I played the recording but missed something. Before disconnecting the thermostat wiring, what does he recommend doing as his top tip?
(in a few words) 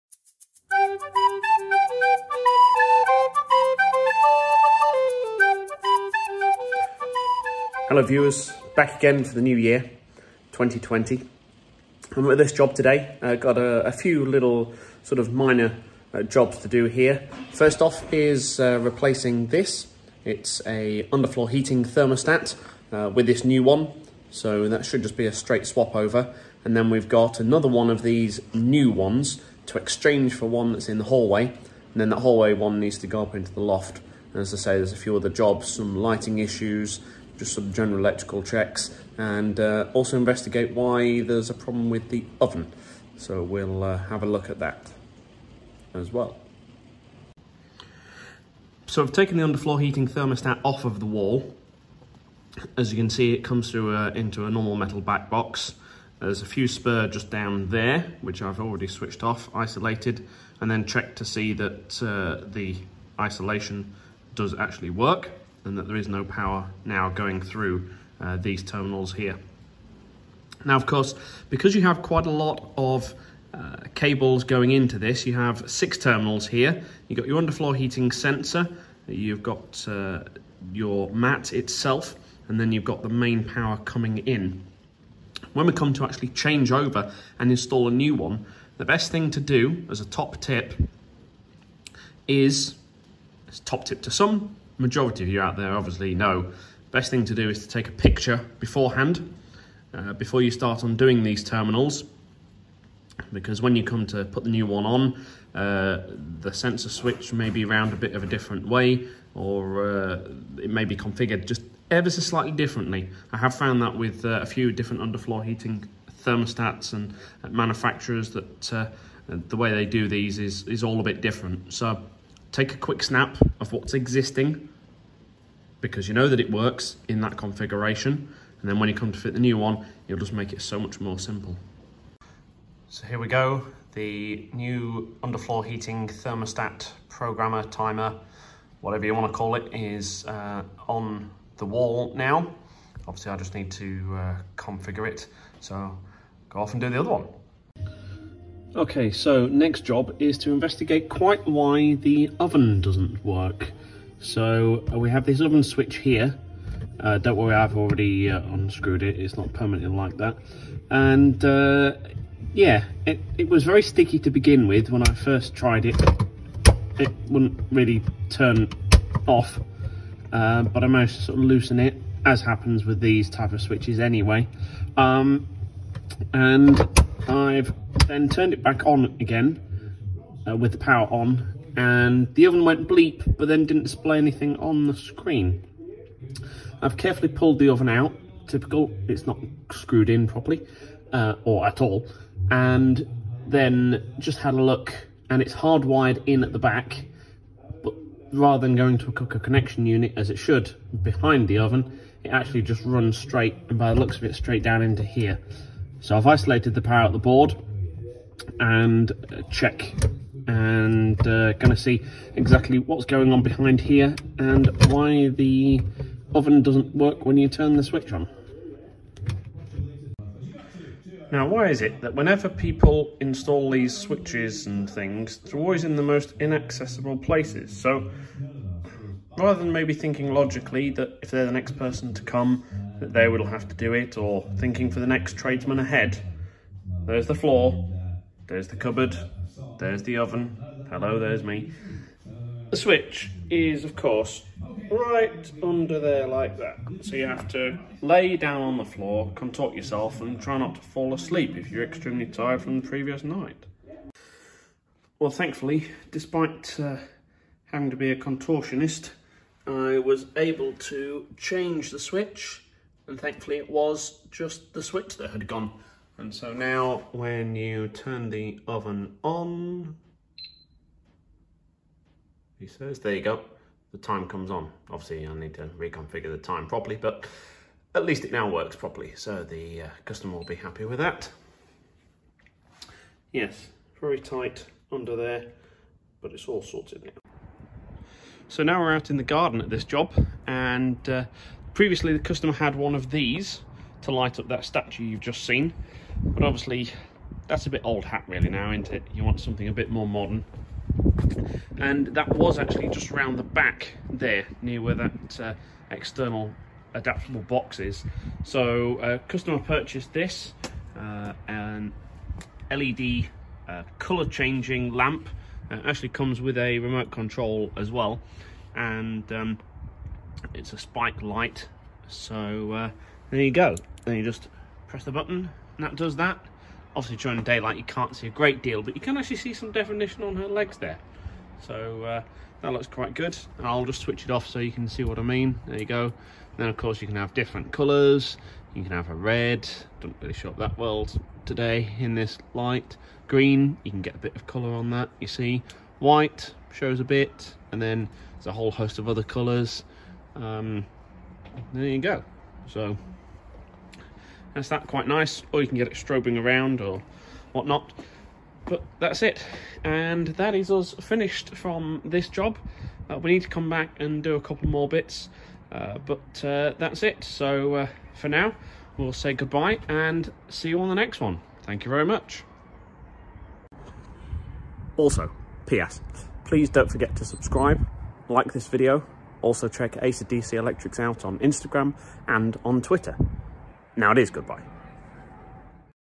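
Take a picture.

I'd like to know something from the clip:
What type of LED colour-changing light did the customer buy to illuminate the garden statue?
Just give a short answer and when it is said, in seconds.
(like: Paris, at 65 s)
Spike light, at 320 s.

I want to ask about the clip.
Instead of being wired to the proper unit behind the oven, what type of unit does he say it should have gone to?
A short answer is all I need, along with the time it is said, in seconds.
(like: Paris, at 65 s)
Cooker connection unit, at 199 s.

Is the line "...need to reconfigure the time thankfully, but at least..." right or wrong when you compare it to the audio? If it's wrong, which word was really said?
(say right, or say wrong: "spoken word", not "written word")
wrong: "properly", not "thankfully".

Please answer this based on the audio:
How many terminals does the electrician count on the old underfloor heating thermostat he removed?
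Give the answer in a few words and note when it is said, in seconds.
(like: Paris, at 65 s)
6, at 75 s.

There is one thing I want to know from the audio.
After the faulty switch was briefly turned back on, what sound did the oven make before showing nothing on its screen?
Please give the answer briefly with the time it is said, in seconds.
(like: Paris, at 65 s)
Bleep, at 182 s.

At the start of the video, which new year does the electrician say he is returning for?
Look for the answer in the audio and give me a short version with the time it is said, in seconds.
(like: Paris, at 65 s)
2020, at 10 s.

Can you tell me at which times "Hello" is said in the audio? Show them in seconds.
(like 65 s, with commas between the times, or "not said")
7 s, 240 s.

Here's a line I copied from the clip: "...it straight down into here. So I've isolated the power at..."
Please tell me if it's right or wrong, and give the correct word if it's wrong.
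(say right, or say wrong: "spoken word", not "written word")
right.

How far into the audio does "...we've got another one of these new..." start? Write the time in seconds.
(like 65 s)
26 s.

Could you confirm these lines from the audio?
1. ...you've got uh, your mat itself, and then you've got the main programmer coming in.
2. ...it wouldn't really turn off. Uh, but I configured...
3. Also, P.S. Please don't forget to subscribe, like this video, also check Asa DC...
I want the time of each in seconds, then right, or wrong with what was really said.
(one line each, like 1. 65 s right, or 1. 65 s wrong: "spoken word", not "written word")
1. 79 s wrong: "power", not "programmer"
2. 166 s wrong: "managed", not "configured"
3. 374 s right.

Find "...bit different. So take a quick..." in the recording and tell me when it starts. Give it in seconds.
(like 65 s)
121 s.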